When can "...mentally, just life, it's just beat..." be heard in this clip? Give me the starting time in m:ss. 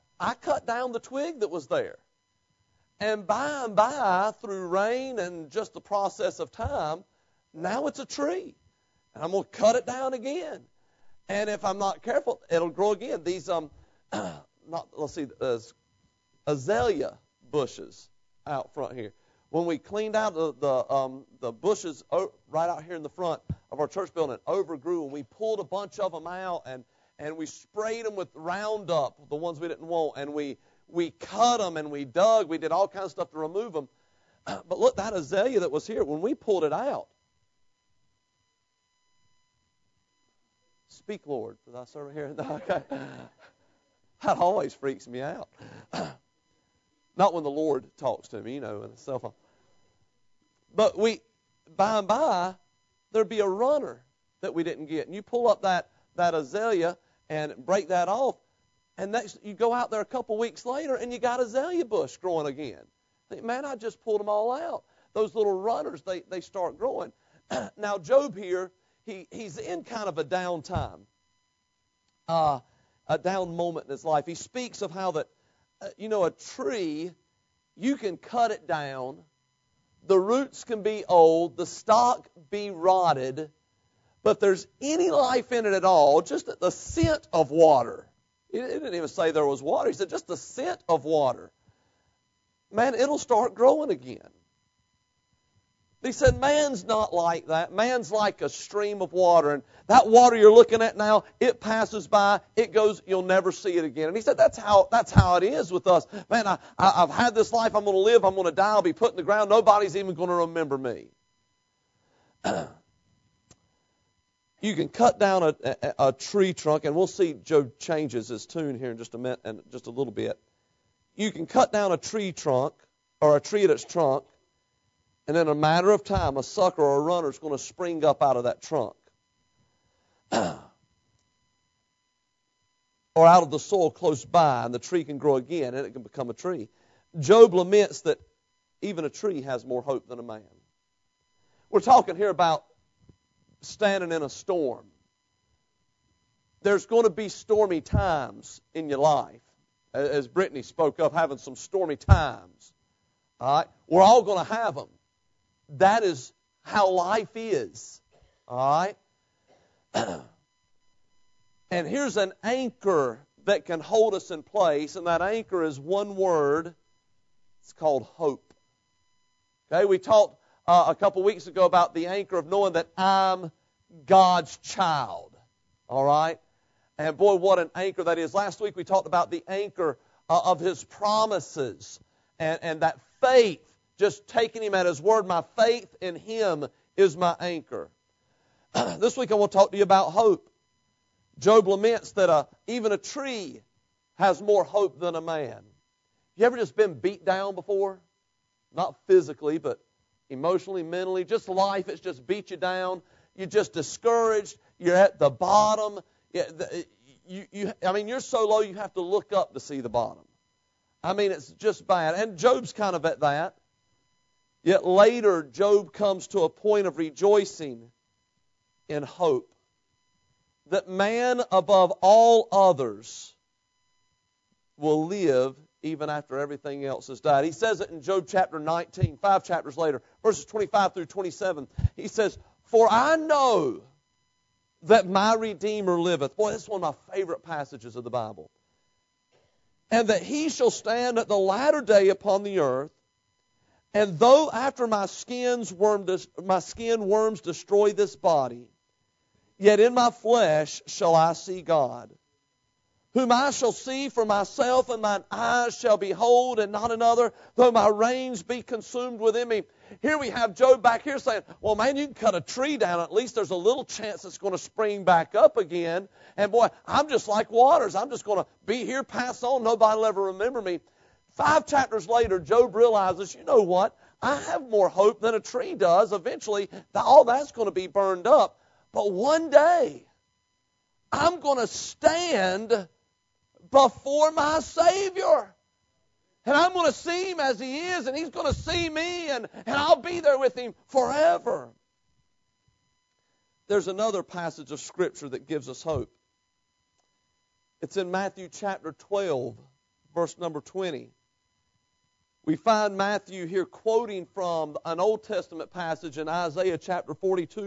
3:20.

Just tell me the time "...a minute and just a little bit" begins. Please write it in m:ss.
1:59.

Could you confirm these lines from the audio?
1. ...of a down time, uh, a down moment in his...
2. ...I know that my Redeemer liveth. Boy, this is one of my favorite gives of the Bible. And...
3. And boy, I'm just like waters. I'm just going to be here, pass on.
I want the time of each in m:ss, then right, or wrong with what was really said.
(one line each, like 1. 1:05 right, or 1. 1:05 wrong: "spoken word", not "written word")
1. 1:10 right
2. 3:52 wrong: "passages", not "gives"
3. 4:26 right.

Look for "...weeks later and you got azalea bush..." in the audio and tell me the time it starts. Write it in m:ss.
1:00.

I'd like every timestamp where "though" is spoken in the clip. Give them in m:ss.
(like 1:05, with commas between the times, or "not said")
4:04, 4:17.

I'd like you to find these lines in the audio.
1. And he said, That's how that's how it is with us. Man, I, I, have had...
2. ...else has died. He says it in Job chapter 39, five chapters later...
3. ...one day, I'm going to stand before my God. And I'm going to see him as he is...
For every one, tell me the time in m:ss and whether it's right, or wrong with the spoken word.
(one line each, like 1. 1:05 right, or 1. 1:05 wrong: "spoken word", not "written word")
1. 1:44 right
2. 3:46 wrong: "19", not "39"
3. 4:39 wrong: "Savior", not "God".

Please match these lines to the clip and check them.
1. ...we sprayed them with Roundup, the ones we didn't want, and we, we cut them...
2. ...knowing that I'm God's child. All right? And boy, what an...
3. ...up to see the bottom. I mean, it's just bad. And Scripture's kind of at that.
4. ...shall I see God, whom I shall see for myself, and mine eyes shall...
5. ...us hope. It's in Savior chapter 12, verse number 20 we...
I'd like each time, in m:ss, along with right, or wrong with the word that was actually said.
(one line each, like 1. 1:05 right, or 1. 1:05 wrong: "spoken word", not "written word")
1. 0:27 right
2. 2:52 right
3. 3:29 wrong: "Job", not "Scripture"
4. 4:10 right
5. 4:55 wrong: "Matthew", not "Savior".